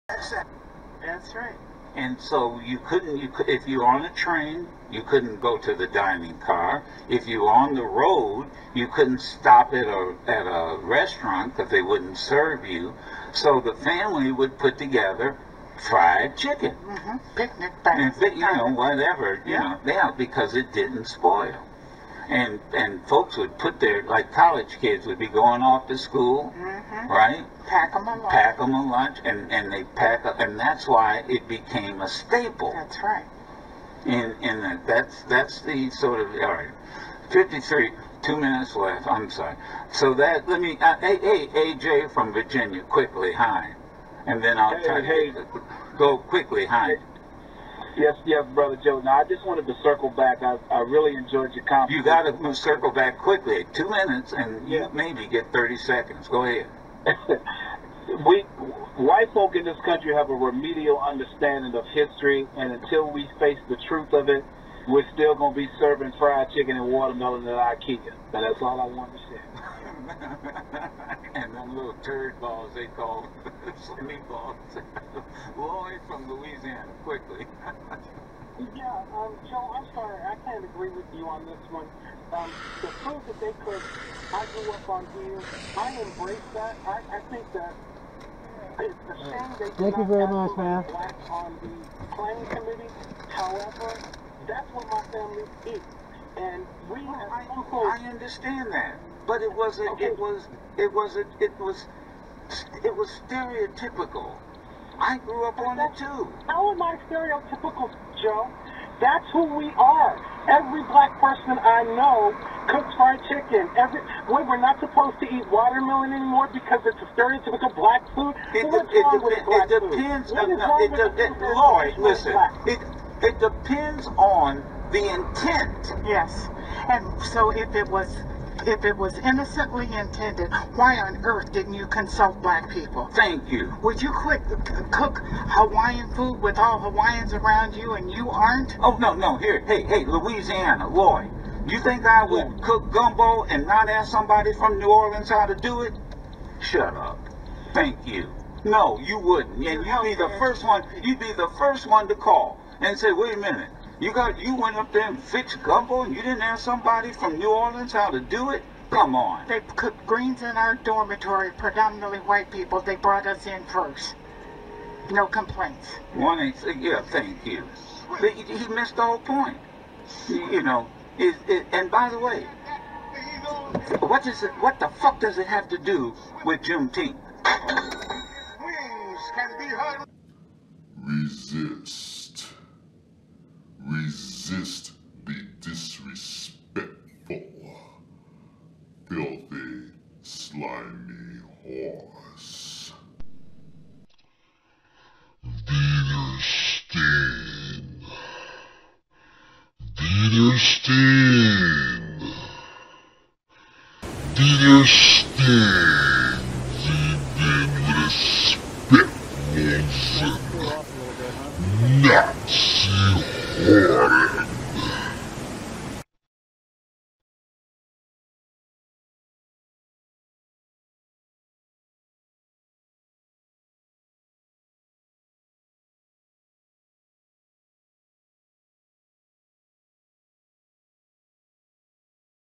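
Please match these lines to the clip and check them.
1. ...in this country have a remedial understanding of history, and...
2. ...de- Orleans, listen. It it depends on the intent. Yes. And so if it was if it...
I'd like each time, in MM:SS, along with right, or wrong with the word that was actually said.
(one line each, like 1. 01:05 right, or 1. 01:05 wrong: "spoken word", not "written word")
1. 00:59 right
2. 02:01 wrong: "Lloyd", not "Orleans".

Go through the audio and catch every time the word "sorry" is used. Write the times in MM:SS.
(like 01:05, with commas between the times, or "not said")
00:39, 01:19.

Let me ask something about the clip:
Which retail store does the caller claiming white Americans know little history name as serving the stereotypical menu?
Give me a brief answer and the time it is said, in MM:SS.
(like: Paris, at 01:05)
IKEA, at 01:07.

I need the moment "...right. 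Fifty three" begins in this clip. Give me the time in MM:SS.
00:36.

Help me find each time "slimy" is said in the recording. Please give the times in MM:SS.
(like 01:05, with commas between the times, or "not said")
01:13, 03:10.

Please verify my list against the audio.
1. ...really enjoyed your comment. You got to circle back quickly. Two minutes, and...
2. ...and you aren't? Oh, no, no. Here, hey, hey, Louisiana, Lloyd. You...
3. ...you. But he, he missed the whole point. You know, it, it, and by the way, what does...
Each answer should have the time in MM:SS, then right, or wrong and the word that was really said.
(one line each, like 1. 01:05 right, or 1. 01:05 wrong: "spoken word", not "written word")
1. 00:50 right
2. 02:17 right
3. 02:47 right.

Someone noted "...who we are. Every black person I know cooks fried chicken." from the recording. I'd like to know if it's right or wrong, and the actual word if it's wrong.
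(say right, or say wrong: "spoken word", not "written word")
right.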